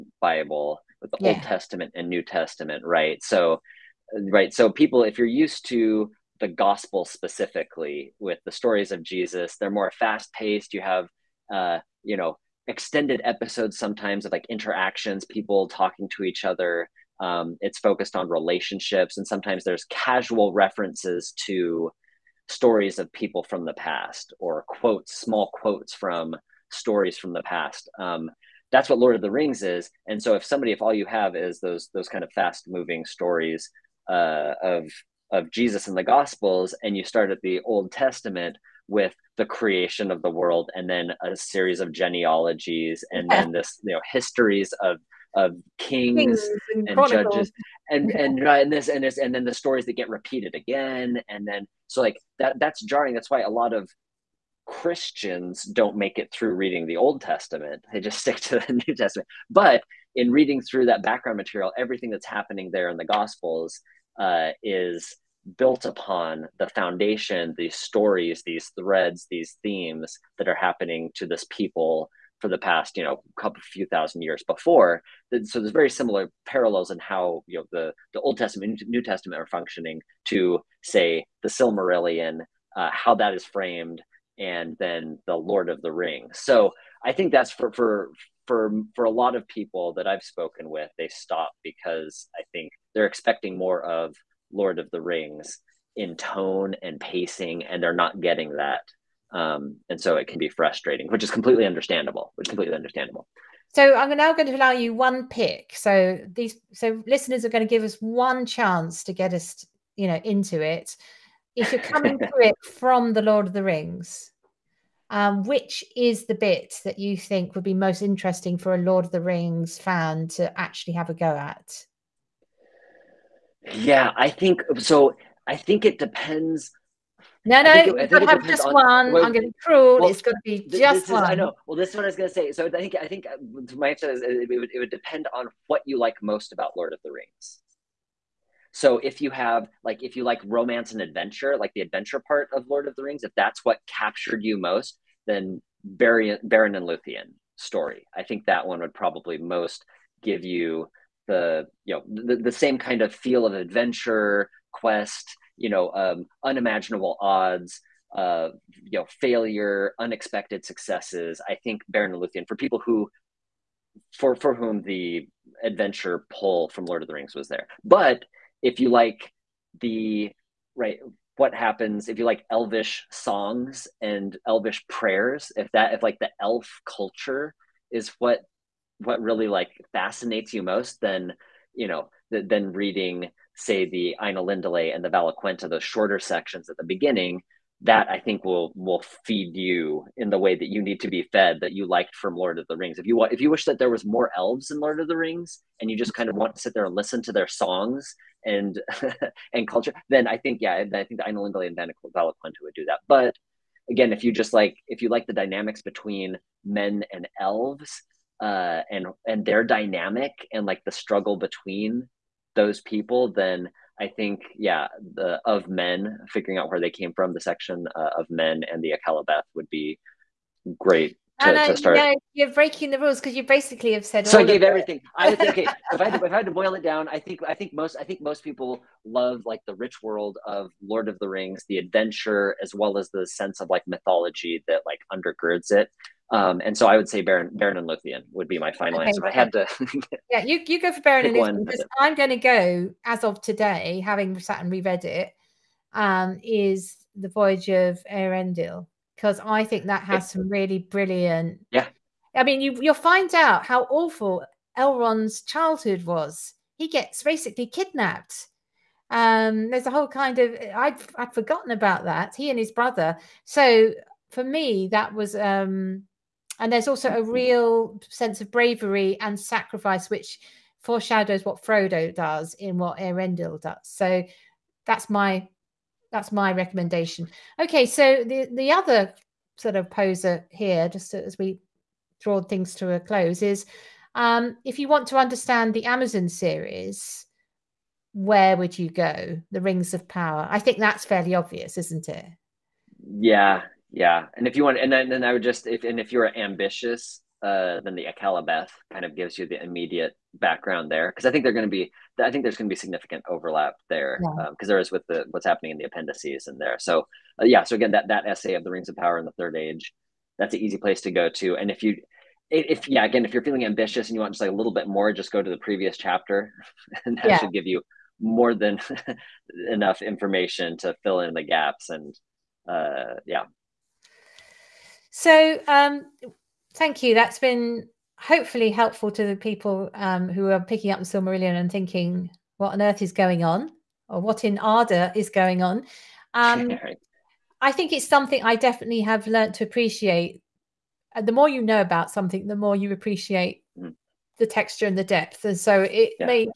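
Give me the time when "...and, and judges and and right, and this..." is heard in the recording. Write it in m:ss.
0:46.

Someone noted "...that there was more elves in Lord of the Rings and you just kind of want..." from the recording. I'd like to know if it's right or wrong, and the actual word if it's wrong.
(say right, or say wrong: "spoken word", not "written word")
right.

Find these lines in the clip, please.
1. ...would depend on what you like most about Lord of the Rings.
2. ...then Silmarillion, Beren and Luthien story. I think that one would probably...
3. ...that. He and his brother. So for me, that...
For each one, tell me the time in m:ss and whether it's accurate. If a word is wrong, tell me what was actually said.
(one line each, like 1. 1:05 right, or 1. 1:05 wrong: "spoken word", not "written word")
1. 2:14 right
2. 2:25 wrong: "Beren", not "Silmarillion"
3. 4:22 right.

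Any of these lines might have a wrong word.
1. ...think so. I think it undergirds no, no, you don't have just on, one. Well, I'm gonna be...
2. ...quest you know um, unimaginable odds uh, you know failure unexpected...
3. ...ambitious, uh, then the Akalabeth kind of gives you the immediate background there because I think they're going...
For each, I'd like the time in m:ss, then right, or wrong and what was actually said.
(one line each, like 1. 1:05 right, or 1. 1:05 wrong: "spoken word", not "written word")
1. 2:04 wrong: "depends", not "undergirds"
2. 2:34 right
3. 4:56 right.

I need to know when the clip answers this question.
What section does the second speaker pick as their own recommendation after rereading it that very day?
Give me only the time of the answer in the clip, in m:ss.
4:07.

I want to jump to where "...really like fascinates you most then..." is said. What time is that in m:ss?
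2:59.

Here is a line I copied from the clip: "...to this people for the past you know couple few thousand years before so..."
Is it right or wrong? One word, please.
right.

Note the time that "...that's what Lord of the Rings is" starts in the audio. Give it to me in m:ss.
0:28.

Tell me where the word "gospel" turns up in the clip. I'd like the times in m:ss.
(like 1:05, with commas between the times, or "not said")
0:06, 0:36, 1:03.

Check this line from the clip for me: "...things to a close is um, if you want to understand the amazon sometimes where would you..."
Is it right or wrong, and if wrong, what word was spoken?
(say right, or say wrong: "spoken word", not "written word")
wrong: "series", not "sometimes".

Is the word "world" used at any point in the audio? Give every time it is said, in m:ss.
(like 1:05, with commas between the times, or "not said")
0:40, 3:50.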